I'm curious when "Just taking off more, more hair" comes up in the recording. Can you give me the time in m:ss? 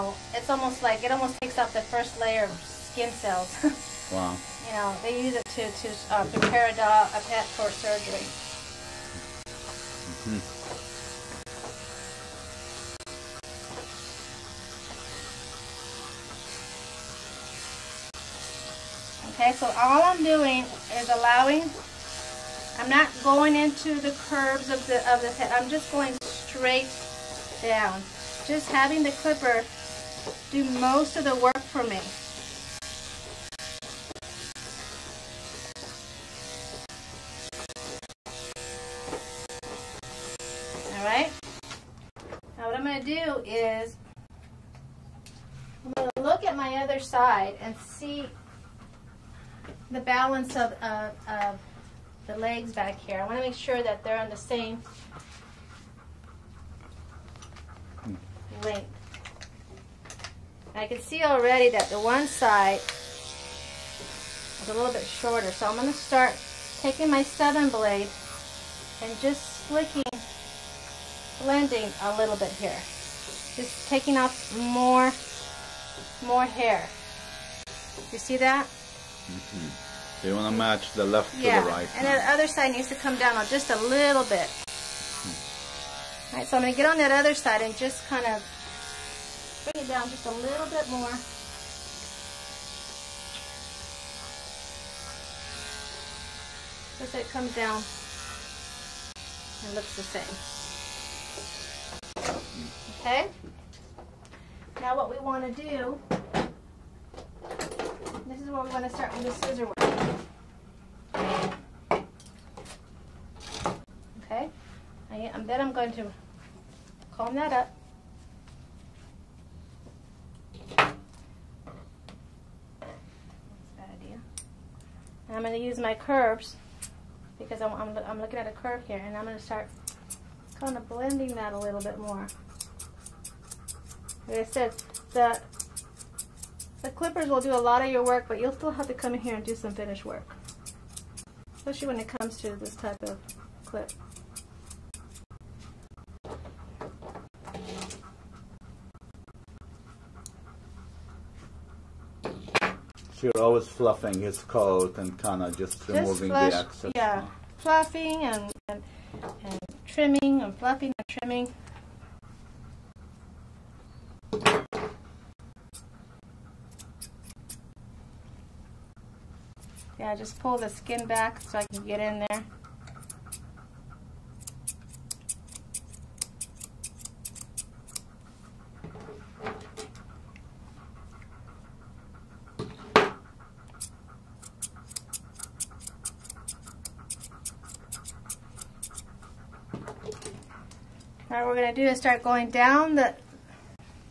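1:13.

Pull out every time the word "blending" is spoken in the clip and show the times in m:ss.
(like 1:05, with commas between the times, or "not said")
1:11, 2:10.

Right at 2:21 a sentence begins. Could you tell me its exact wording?
Especially when it comes to this type of clip.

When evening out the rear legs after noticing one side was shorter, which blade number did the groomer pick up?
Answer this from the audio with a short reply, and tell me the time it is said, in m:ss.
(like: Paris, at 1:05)
7, at 1:07.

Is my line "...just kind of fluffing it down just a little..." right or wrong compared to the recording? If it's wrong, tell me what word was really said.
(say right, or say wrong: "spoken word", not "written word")
wrong: "bring", not "fluffing".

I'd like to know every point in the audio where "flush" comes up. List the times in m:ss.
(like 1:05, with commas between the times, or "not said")
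2:36.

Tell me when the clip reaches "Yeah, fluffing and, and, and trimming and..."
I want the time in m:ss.
2:36.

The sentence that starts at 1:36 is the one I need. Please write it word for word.
Just so it comes down and looks the same.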